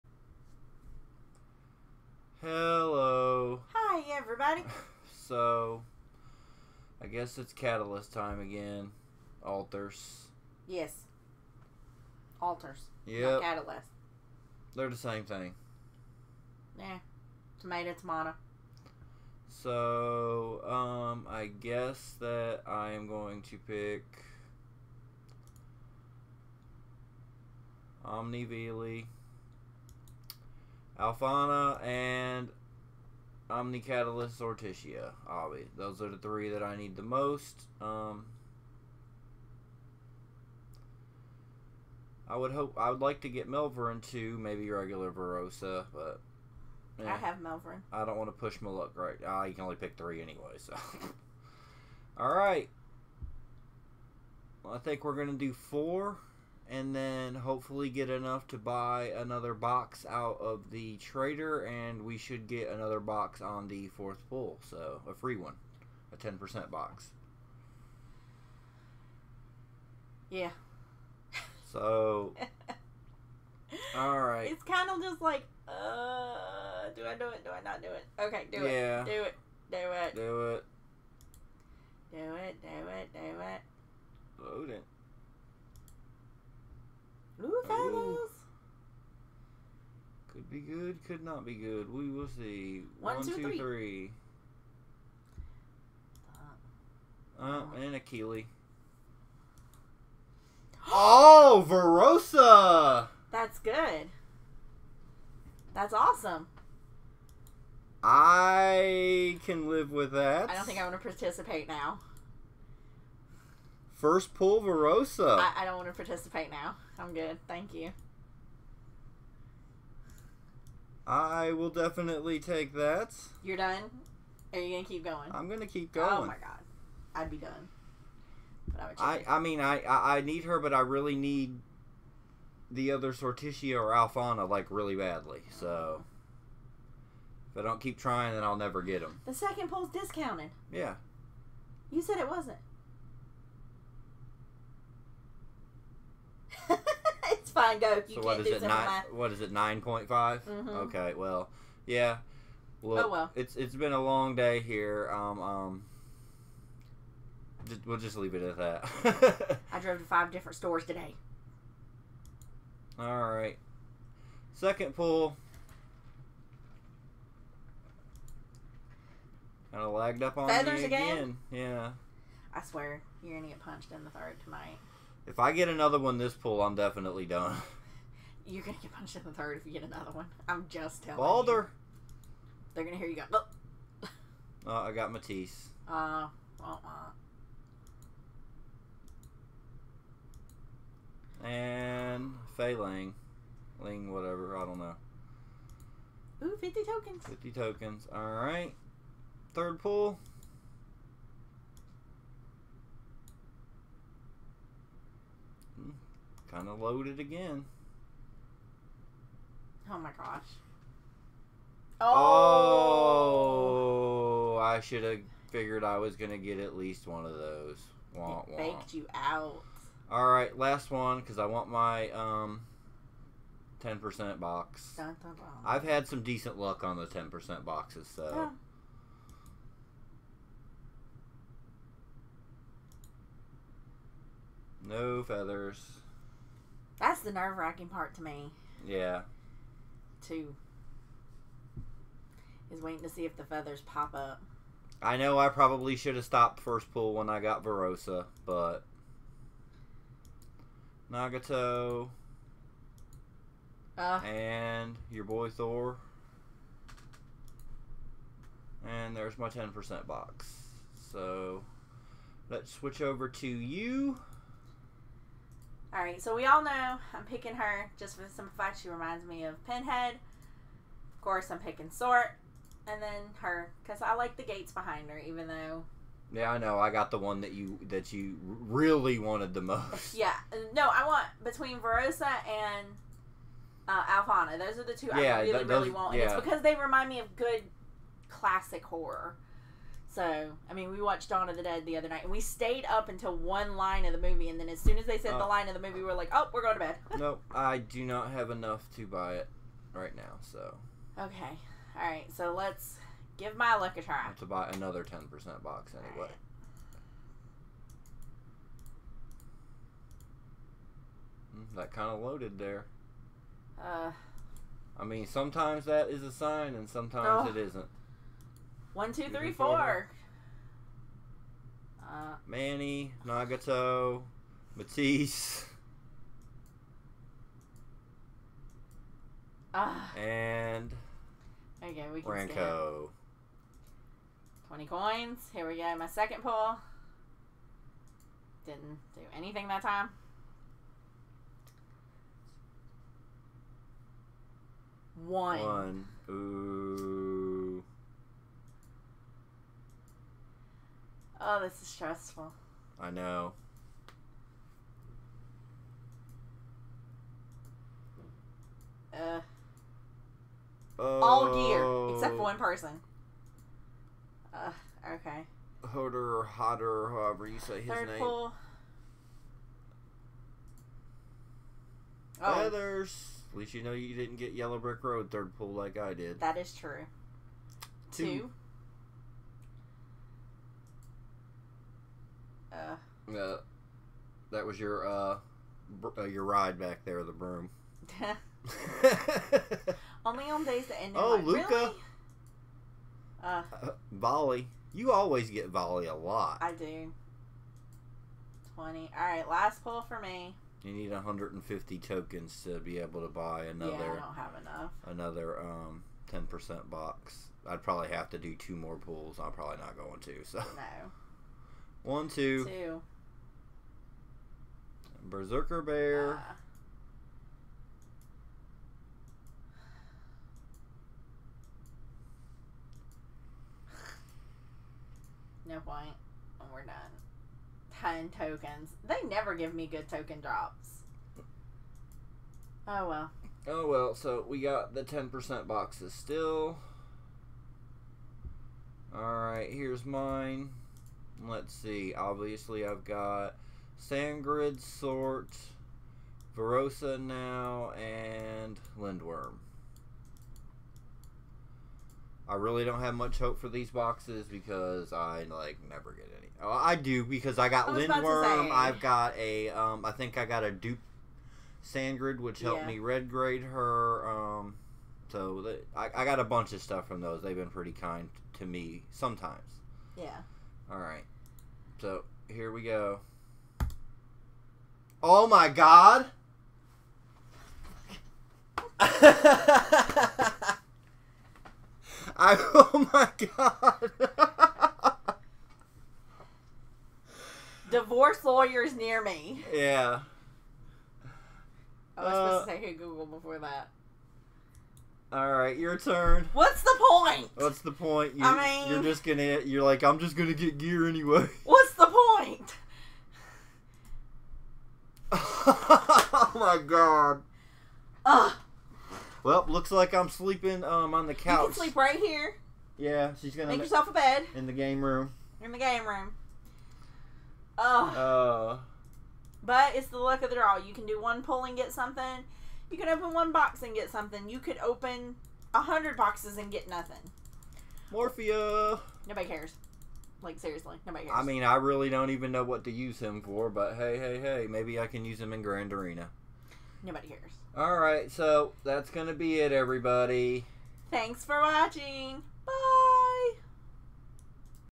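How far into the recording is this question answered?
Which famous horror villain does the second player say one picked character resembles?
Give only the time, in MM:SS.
04:29.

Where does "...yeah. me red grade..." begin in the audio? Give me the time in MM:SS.
07:42.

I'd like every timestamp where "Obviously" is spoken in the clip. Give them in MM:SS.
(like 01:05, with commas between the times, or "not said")
00:35, 07:22.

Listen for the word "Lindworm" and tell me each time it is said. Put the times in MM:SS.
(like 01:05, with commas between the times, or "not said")
07:28, 07:37.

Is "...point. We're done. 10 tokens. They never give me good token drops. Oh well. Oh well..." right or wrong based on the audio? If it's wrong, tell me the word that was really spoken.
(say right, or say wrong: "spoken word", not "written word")
right.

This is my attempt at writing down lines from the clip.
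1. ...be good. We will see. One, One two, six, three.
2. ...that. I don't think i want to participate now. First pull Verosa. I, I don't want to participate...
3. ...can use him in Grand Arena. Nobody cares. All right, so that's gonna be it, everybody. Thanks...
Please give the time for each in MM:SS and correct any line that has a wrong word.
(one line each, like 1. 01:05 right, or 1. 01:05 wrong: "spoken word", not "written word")
1. 01:31 wrong: "two", not "six"
2. 01:50 right
3. 08:55 right.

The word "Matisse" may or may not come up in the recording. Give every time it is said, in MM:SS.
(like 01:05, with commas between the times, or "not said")
03:05, 05:24.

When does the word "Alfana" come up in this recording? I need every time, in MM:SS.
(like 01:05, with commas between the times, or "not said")
00:31, 02:13, 04:44.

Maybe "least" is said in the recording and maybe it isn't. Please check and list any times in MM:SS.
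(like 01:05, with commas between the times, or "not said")
03:36, 06:13.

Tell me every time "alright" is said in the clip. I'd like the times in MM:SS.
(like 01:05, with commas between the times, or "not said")
03:18, 07:19, 07:50.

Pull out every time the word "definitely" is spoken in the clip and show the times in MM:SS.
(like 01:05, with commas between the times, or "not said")
02:01, 02:56.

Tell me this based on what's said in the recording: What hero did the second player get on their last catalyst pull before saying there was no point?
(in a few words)
Berserker Bear.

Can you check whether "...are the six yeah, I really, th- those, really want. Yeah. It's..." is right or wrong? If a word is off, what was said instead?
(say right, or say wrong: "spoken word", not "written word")
wrong: "two", not "six".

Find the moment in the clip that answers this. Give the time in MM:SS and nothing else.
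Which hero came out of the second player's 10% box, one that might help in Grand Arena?
08:48.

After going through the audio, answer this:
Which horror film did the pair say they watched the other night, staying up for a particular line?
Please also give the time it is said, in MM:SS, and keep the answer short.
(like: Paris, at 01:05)
Dawn of the Dead, at 04:51.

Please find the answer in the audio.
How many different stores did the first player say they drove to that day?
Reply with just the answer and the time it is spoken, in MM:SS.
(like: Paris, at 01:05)
5, at 02:40.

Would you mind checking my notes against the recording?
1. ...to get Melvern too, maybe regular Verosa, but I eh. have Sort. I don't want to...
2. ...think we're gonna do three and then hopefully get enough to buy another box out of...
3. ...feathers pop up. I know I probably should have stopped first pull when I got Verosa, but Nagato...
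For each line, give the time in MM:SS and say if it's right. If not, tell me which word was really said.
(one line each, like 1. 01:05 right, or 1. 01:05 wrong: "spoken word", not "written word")
1. 00:43 wrong: "Melvern", not "Sort"
2. 00:54 wrong: "four", not "three"
3. 04:03 right.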